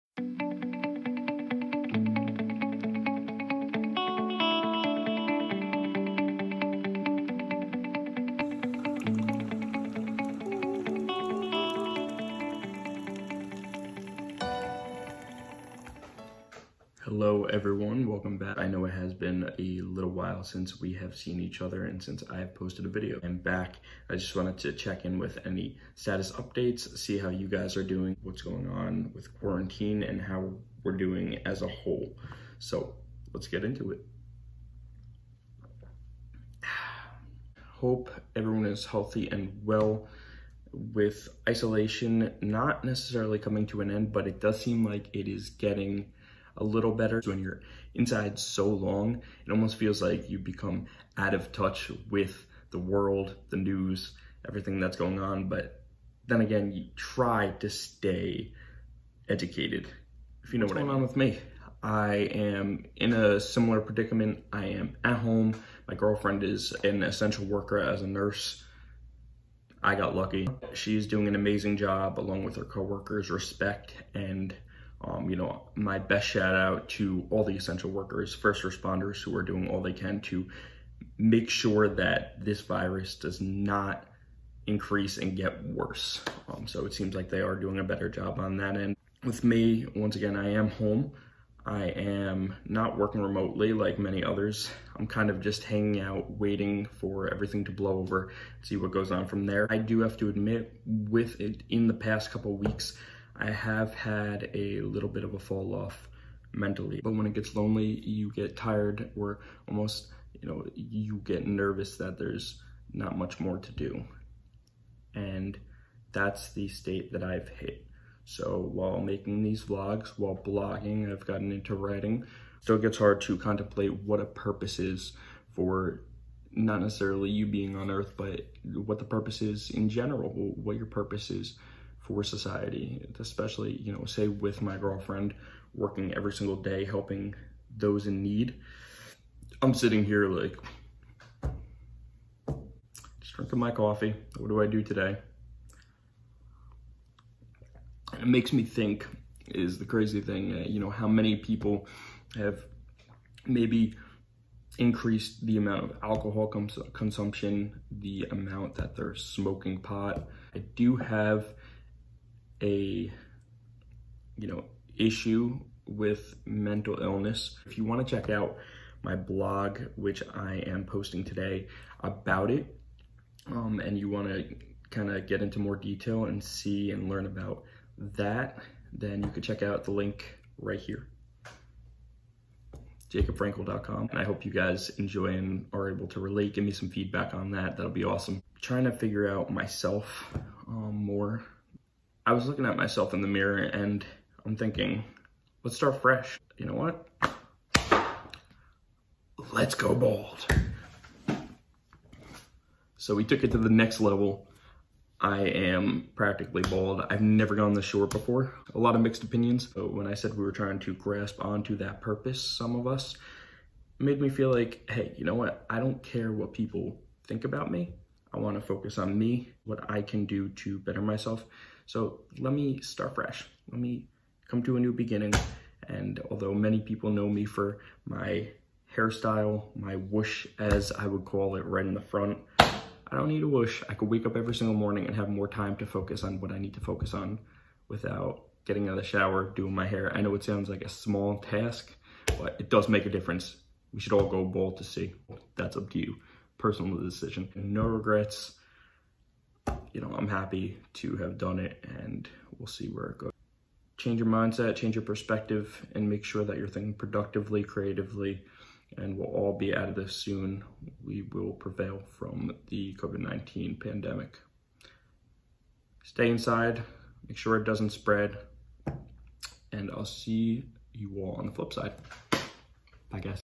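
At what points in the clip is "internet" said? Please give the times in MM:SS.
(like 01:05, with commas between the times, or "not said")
not said.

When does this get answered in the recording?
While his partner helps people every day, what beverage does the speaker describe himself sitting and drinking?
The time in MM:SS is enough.
02:23.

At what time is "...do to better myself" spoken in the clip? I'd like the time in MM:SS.
03:40.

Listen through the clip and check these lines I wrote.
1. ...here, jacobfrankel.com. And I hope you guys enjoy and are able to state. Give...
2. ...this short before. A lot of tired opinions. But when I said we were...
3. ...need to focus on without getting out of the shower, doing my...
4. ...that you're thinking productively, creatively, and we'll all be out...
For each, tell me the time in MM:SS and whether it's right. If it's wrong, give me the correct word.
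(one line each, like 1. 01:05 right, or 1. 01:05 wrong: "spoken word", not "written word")
1. 03:00 wrong: "relate", not "state"
2. 03:27 wrong: "mixed", not "tired"
3. 03:56 right
4. 04:16 right.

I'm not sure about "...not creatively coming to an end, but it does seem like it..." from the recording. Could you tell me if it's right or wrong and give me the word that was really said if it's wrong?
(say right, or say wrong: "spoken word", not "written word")
wrong: "necessarily", not "creatively".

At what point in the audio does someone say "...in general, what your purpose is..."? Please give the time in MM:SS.
02:09.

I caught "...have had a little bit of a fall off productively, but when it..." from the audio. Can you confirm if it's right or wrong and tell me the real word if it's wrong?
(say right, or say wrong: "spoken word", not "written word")
wrong: "mentally", not "productively".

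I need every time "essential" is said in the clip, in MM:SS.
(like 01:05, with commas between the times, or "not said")
01:07, 01:17.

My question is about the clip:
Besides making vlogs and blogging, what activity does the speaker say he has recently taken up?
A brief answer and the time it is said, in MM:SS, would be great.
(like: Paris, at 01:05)
Writing, at 02:01.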